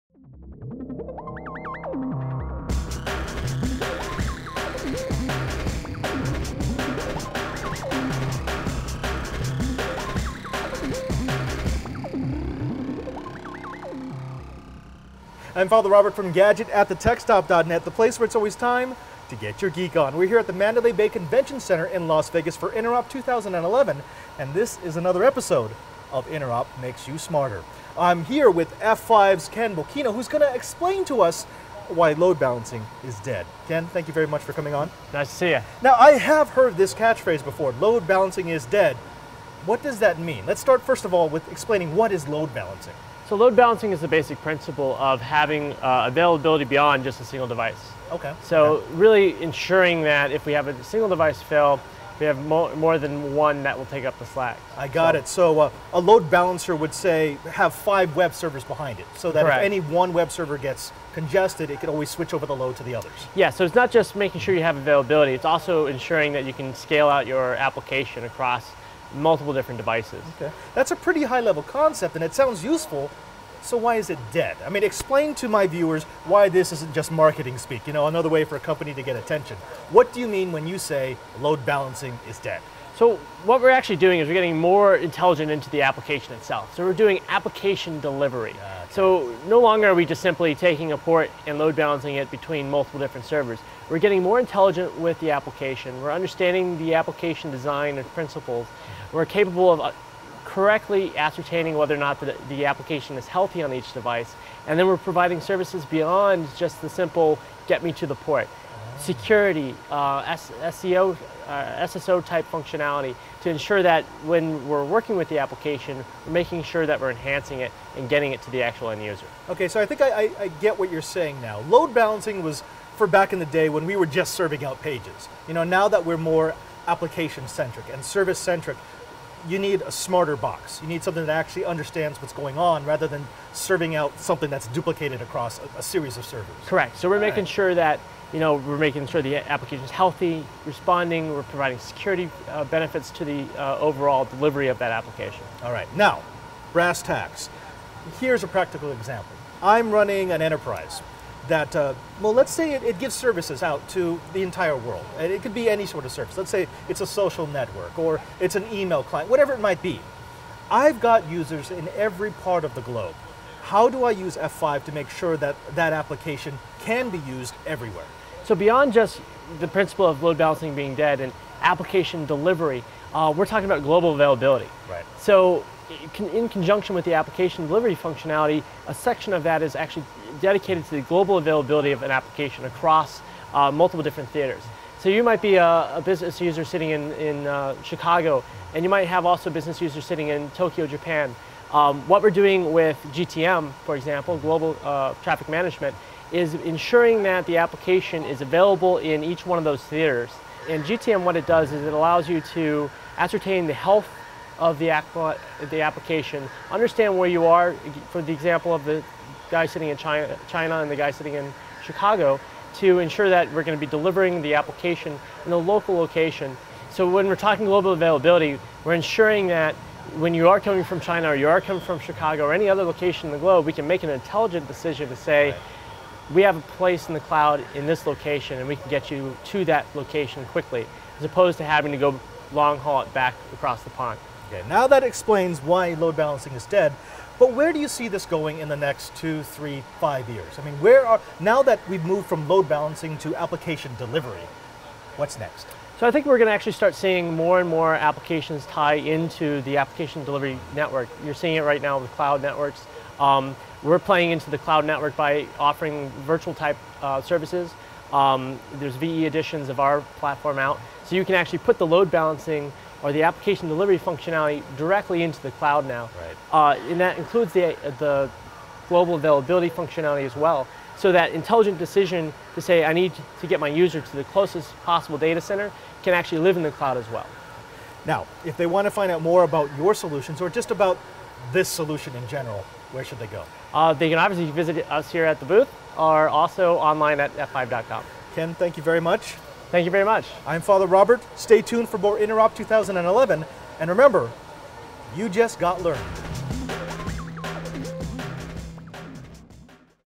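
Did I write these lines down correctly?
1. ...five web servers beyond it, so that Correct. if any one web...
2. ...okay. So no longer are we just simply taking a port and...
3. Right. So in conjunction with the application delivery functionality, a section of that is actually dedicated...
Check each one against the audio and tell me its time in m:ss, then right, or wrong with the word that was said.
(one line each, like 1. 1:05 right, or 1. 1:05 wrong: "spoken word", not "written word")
1. 0:57 wrong: "behind", not "beyond"
2. 1:28 right
3. 2:54 right.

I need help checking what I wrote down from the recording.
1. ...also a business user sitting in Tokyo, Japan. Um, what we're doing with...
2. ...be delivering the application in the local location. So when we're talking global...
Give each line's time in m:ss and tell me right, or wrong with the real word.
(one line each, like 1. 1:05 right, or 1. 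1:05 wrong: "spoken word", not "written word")
1. 3:09 right
2. 3:33 right.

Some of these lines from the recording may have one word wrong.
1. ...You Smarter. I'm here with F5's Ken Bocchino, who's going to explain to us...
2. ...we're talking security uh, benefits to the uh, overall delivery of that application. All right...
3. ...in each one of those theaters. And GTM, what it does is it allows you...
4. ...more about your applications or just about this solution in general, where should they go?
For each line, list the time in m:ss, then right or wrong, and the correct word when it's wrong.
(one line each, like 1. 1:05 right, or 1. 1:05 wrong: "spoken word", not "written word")
1. 0:27 right
2. 2:21 wrong: "providing", not "talking"
3. 3:18 right
4. 4:39 wrong: "solutions", not "applications".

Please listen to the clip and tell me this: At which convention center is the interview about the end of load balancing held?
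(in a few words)
Mandalay Bay Convention Center.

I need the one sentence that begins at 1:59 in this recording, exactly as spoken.
Okay, so I think I, I, I get what you're saying now.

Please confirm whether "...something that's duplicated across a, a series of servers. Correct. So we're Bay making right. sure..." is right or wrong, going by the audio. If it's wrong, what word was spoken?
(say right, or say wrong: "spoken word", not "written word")
wrong: "All", not "Bay".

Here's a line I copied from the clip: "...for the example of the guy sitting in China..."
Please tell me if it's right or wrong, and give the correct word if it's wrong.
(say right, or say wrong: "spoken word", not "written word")
right.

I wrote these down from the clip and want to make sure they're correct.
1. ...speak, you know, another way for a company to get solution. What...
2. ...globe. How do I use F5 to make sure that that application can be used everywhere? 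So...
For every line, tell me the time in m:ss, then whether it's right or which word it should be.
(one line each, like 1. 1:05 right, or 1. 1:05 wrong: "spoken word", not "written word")
1. 1:17 wrong: "attention", not "solution"
2. 2:42 right.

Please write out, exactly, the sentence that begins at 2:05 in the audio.
You know, now that we're more application centric and service centric, you need a smarter box.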